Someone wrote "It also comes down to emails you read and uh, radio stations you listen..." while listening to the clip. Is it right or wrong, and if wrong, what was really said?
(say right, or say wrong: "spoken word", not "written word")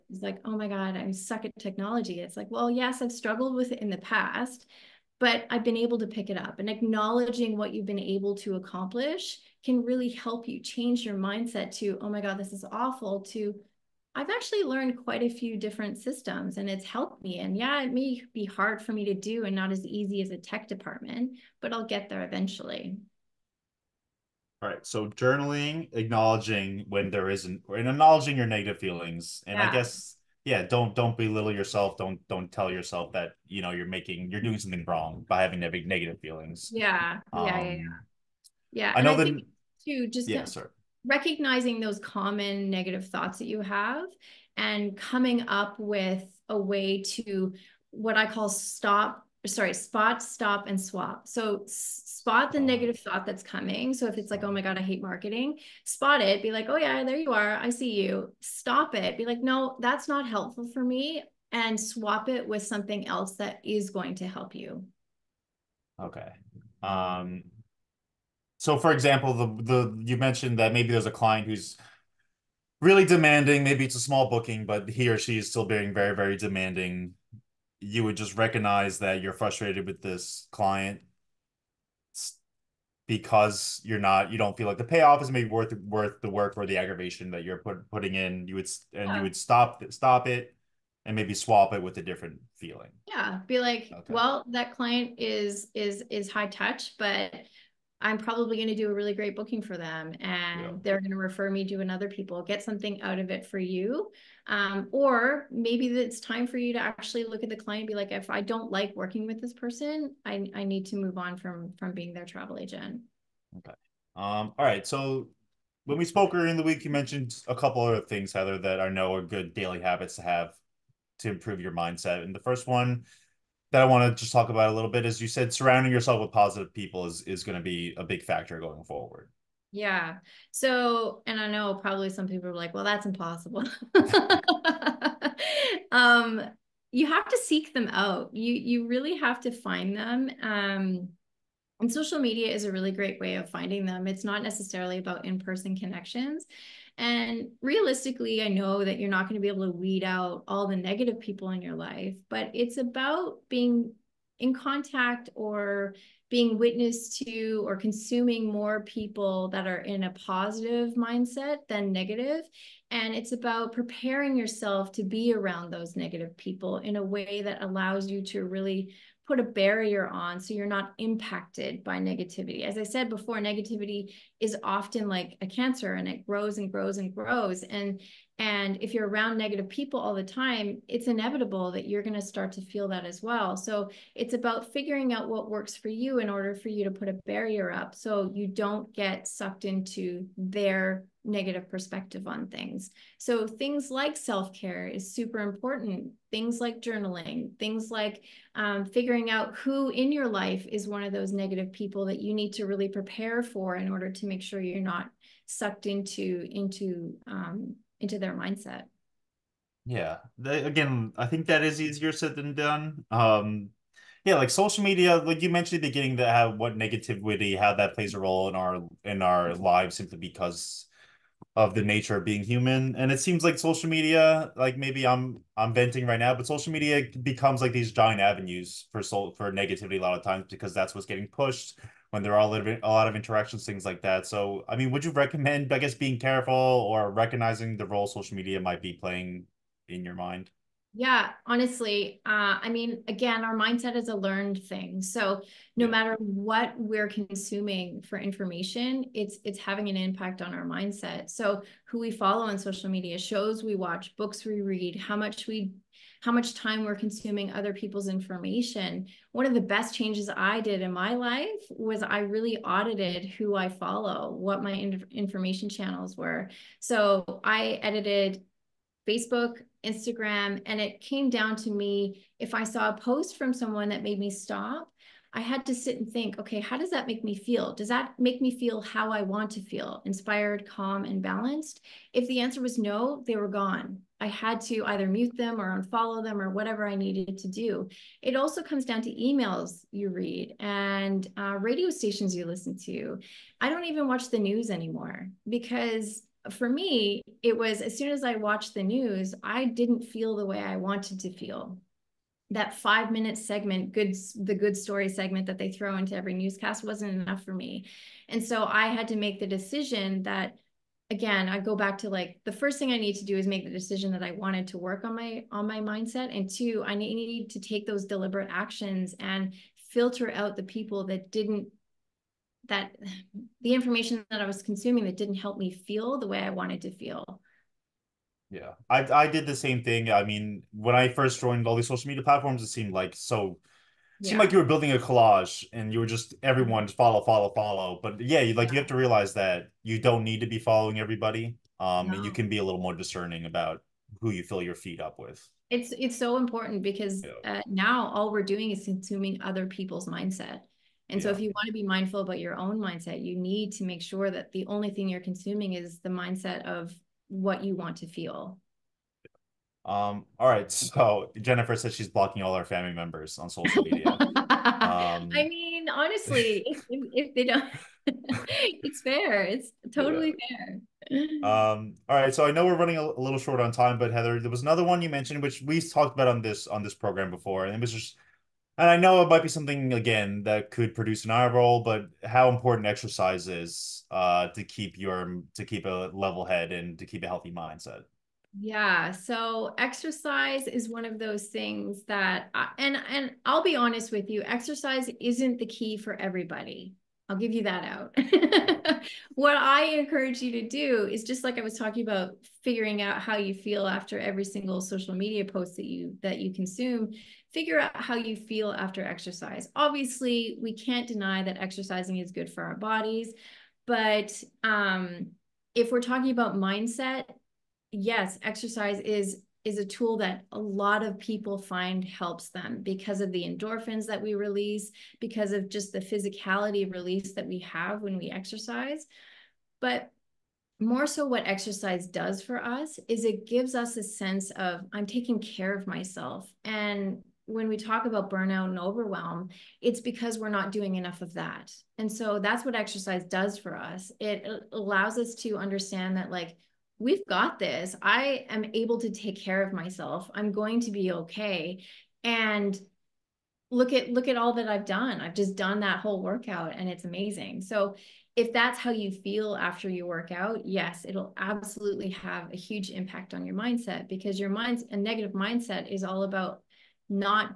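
right.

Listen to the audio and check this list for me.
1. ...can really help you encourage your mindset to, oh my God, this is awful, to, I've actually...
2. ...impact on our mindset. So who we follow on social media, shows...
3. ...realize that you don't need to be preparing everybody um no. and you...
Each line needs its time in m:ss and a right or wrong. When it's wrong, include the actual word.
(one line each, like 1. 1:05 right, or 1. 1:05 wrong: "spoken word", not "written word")
1. 0:09 wrong: "change", not "encourage"
2. 4:09 right
3. 5:38 wrong: "following", not "preparing".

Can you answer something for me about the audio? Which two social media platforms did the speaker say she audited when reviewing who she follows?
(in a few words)
Facebook, Instagram.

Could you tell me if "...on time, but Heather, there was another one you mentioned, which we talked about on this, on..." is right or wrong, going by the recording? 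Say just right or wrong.
right.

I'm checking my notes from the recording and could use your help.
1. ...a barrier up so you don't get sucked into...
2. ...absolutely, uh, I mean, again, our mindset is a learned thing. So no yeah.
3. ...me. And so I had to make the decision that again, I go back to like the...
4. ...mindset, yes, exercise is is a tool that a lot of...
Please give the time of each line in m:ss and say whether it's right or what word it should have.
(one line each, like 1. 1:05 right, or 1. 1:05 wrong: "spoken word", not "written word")
1. 3:07 right
2. 4:01 wrong: "honestly", not "absolutely"
3. 5:07 right
4. 6:56 right.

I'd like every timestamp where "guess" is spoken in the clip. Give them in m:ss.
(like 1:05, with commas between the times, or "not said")
0:29, 3:55.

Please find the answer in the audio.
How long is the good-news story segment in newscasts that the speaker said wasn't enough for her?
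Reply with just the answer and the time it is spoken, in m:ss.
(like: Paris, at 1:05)
5 minutes, at 5:02.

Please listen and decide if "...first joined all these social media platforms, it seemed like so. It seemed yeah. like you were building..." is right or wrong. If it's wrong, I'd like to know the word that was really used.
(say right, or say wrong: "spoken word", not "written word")
right.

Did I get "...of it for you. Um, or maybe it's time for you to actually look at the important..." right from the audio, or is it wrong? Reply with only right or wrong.
wrong.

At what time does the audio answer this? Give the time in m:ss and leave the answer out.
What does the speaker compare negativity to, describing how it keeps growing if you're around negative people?
2:55.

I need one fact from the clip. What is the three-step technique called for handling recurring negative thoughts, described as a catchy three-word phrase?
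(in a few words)
spot, stop, and swap.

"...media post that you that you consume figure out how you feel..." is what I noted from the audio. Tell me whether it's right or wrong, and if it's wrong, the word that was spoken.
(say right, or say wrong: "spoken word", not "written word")
right.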